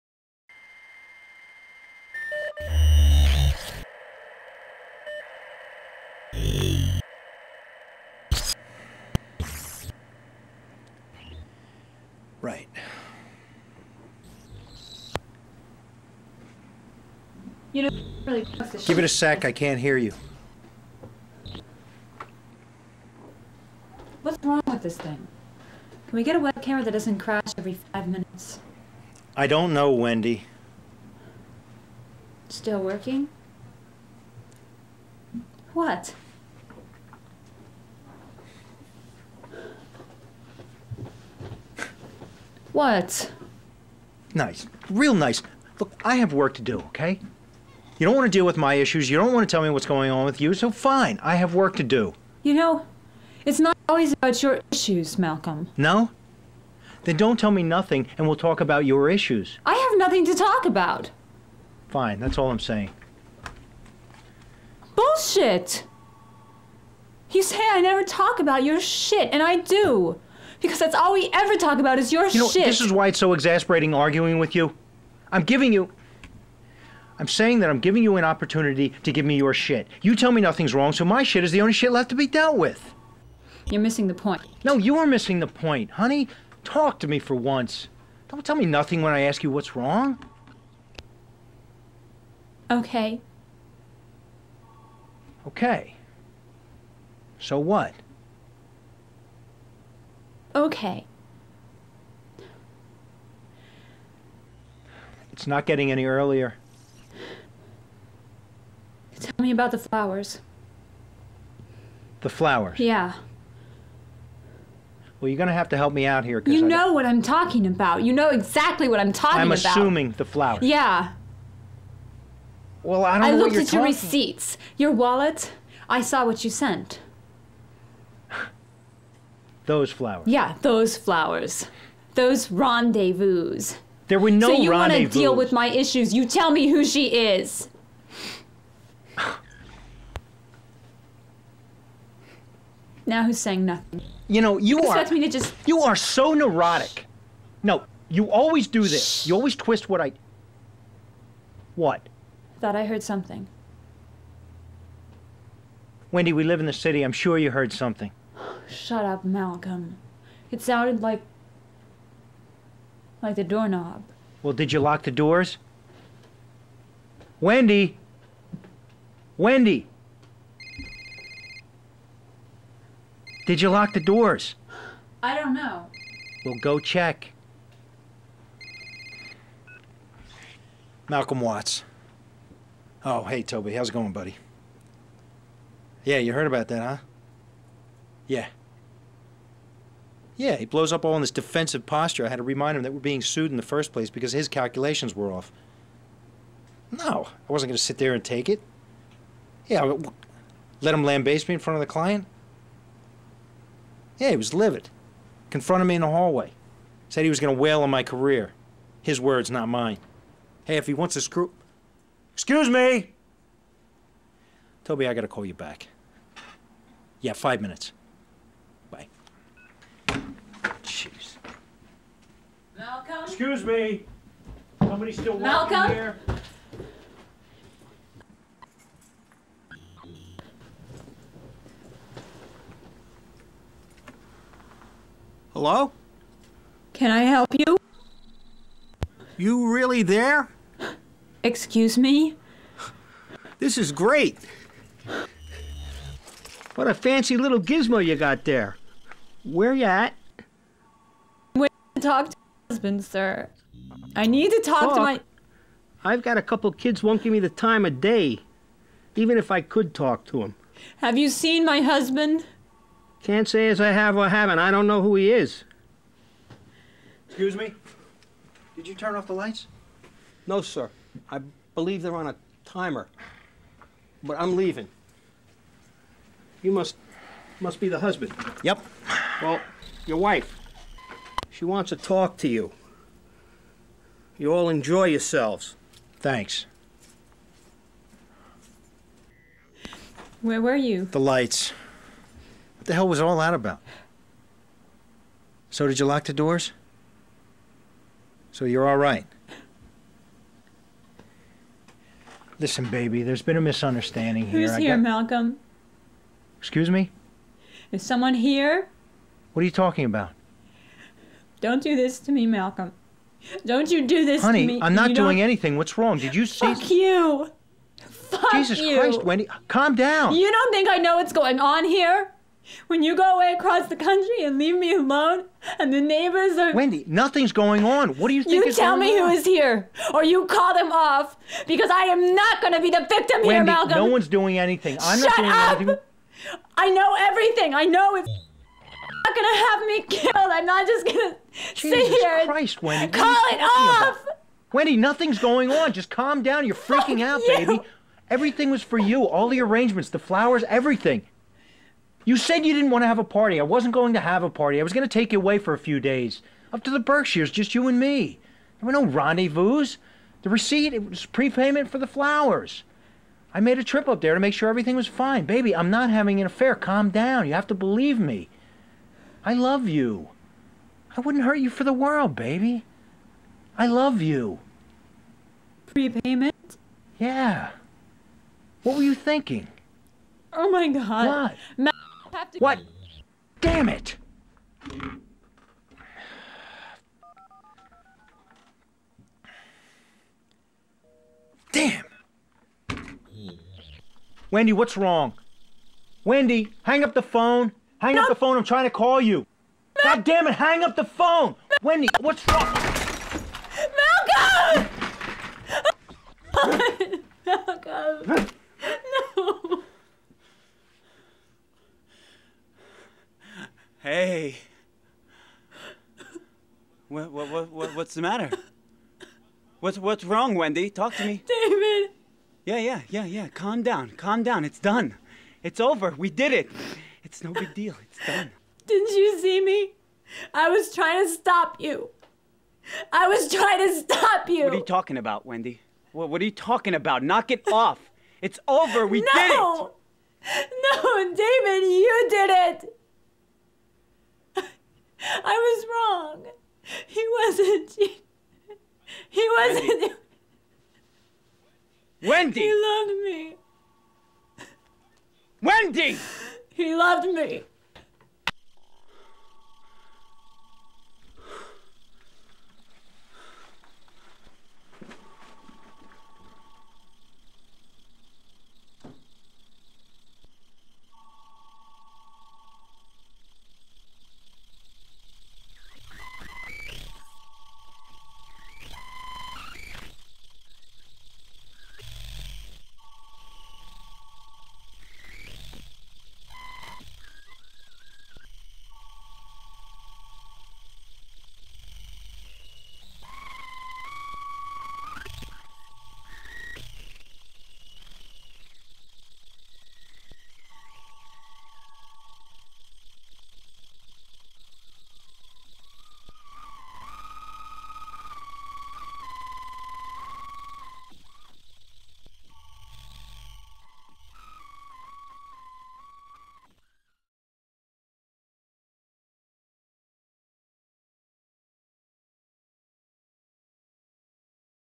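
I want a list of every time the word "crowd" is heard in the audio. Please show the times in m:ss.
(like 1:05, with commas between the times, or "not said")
not said.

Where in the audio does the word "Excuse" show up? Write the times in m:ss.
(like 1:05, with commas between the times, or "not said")
3:32, 3:43, 4:01, 4:27, 5:06.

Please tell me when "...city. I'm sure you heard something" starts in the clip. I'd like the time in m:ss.
2:36.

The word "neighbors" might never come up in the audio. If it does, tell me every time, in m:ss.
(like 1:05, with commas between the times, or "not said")
5:26.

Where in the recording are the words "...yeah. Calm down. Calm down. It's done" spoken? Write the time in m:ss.
7:03.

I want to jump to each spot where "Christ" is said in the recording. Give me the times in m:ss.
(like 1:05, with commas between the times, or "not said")
5:18, 5:42.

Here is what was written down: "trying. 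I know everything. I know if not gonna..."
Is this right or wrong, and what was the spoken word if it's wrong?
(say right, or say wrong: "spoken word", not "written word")
wrong: "anything", not "trying".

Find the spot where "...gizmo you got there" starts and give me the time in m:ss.
4:07.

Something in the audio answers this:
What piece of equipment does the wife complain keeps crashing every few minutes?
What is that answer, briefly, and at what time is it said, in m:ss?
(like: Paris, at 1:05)
Web camera, at 0:26.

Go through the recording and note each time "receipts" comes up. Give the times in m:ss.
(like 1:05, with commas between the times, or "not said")
2:03, 6:00.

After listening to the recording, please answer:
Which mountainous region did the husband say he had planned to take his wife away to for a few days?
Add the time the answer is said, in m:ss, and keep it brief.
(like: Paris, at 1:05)
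The Berkshires, at 5:56.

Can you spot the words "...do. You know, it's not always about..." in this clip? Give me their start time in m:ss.
0:51.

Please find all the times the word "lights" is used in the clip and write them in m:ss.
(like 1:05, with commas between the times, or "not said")
4:29, 4:51.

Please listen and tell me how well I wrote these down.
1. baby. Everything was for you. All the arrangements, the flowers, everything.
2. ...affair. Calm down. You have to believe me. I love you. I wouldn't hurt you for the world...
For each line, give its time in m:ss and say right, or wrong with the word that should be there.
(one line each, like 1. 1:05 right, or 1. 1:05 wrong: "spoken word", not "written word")
1. 5:47 right
2. 6:06 right.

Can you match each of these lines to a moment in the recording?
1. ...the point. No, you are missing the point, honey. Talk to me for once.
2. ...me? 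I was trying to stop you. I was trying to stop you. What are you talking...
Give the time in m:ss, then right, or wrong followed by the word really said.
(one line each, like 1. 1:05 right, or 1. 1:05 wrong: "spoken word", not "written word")
1. 1:24 right
2. 7:09 right.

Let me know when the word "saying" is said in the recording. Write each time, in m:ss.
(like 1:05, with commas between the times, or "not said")
1:02, 1:17, 2:23.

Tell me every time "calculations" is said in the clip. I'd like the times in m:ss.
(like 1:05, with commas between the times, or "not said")
3:14.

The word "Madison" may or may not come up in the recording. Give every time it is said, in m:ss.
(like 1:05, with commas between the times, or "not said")
not said.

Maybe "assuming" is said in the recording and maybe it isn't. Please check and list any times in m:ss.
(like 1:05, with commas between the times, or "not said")
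1:59.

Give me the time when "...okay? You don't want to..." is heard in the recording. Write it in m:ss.
0:46.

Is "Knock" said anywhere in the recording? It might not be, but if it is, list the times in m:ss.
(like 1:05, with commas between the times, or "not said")
7:17.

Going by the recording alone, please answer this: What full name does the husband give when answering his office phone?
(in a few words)
Malcolm Watts.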